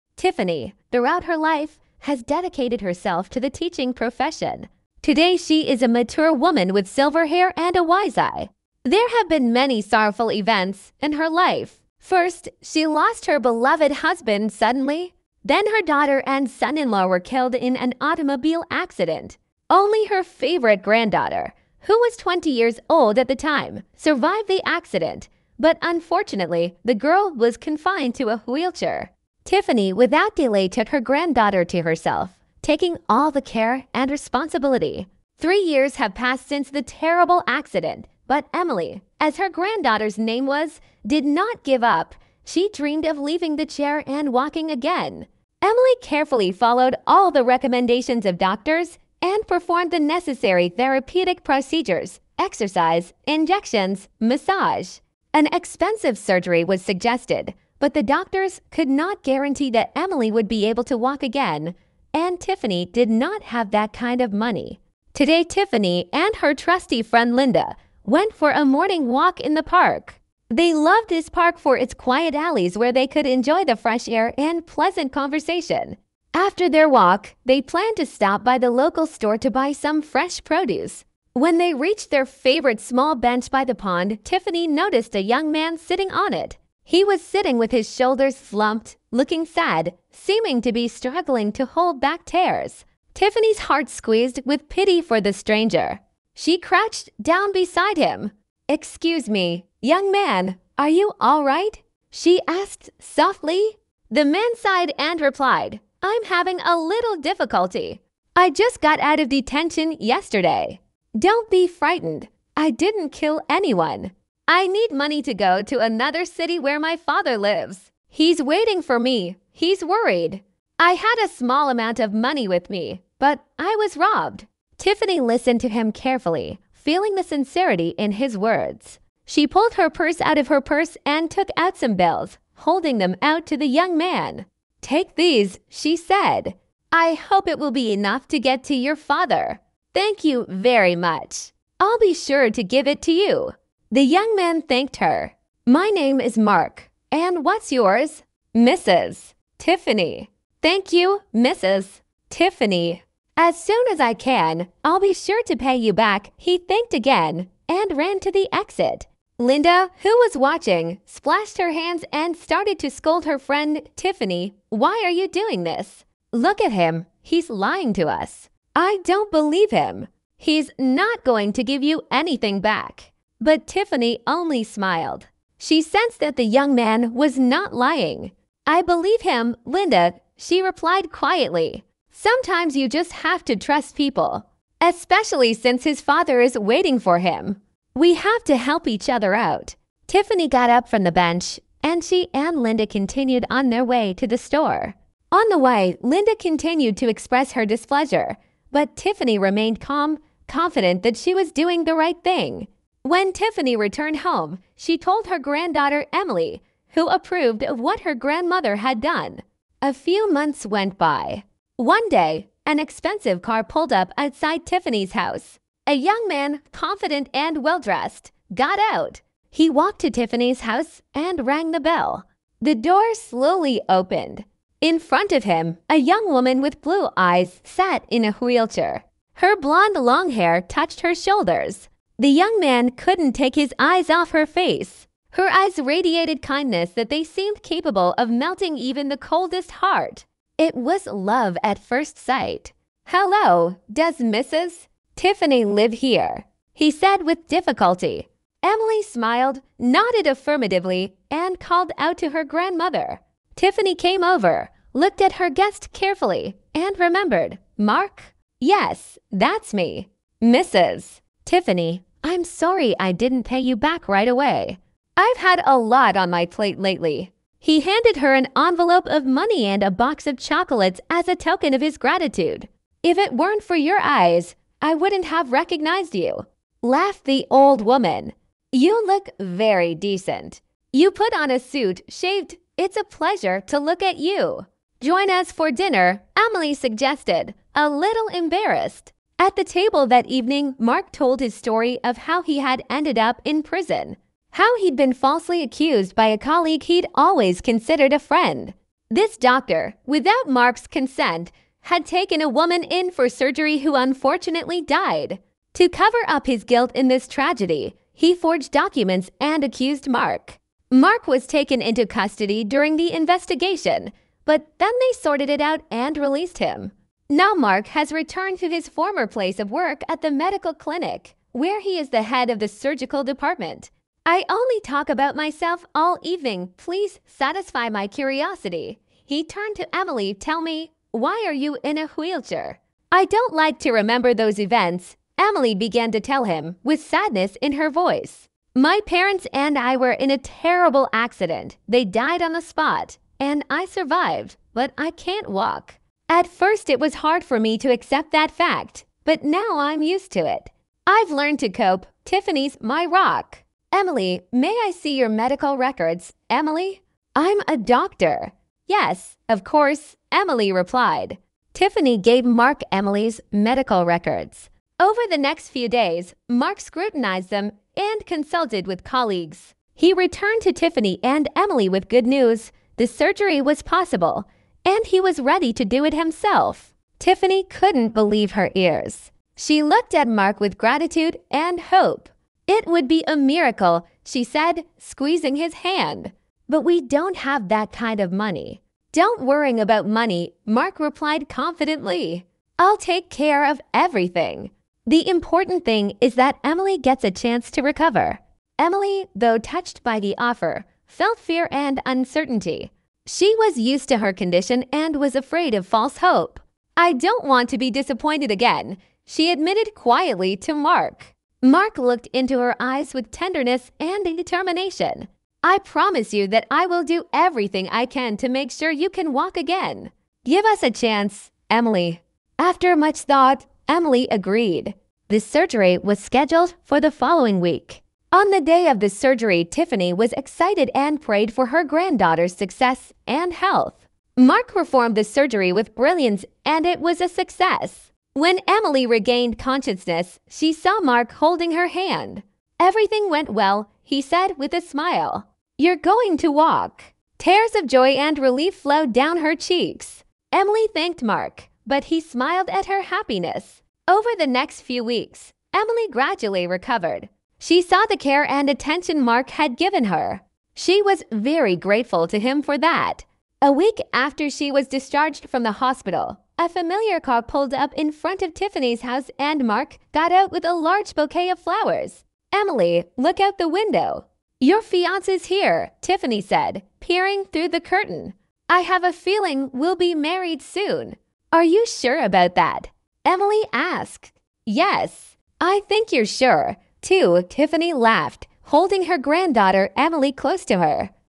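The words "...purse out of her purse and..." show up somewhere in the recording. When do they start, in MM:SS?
02:09.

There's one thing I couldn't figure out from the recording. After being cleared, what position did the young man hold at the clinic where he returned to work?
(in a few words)
Head of the surgical department.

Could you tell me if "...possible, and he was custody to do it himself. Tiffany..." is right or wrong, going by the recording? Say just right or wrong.
wrong.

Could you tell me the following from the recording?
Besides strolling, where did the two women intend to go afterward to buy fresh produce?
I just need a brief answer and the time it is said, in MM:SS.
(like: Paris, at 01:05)
The local store, at 01:18.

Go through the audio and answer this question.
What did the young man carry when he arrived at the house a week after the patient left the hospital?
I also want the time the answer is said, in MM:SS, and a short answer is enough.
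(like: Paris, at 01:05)
A large bouquet of flowers, at 07:50.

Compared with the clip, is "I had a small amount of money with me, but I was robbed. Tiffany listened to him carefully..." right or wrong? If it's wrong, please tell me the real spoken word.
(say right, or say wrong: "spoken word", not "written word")
right.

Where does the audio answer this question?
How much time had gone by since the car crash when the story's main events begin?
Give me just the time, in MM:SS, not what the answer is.
00:35.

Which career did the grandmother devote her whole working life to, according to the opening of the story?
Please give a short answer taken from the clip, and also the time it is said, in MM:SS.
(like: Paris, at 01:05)
Teaching, at 00:03.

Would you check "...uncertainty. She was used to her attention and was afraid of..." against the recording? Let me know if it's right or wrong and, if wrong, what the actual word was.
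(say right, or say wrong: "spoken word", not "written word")
wrong: "condition", not "attention".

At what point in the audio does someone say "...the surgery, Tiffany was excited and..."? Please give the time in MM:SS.
07:09.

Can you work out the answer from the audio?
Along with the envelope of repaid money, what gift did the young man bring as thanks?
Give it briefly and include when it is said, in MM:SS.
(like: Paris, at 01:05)
A box of chocolates, at 04:29.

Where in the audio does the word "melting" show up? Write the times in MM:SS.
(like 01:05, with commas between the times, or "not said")
03:58.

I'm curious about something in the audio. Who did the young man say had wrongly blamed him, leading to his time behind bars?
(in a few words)
A colleague.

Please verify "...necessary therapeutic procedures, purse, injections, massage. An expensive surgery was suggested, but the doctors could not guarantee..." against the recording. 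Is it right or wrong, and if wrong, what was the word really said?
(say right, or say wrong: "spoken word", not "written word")
wrong: "exercise", not "purse".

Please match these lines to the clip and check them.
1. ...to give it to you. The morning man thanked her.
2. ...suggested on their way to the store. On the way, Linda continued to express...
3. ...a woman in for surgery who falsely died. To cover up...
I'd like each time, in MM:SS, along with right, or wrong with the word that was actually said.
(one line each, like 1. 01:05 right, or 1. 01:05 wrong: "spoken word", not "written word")
1. 02:22 wrong: "young", not "morning"
2. 03:12 wrong: "continued", not "suggested"
3. 05:02 wrong: "unfortunately", not "falsely".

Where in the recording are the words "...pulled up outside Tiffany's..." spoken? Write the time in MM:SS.
03:33.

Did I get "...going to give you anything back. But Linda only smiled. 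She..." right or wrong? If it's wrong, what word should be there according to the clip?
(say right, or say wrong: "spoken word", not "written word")
wrong: "Tiffany", not "Linda".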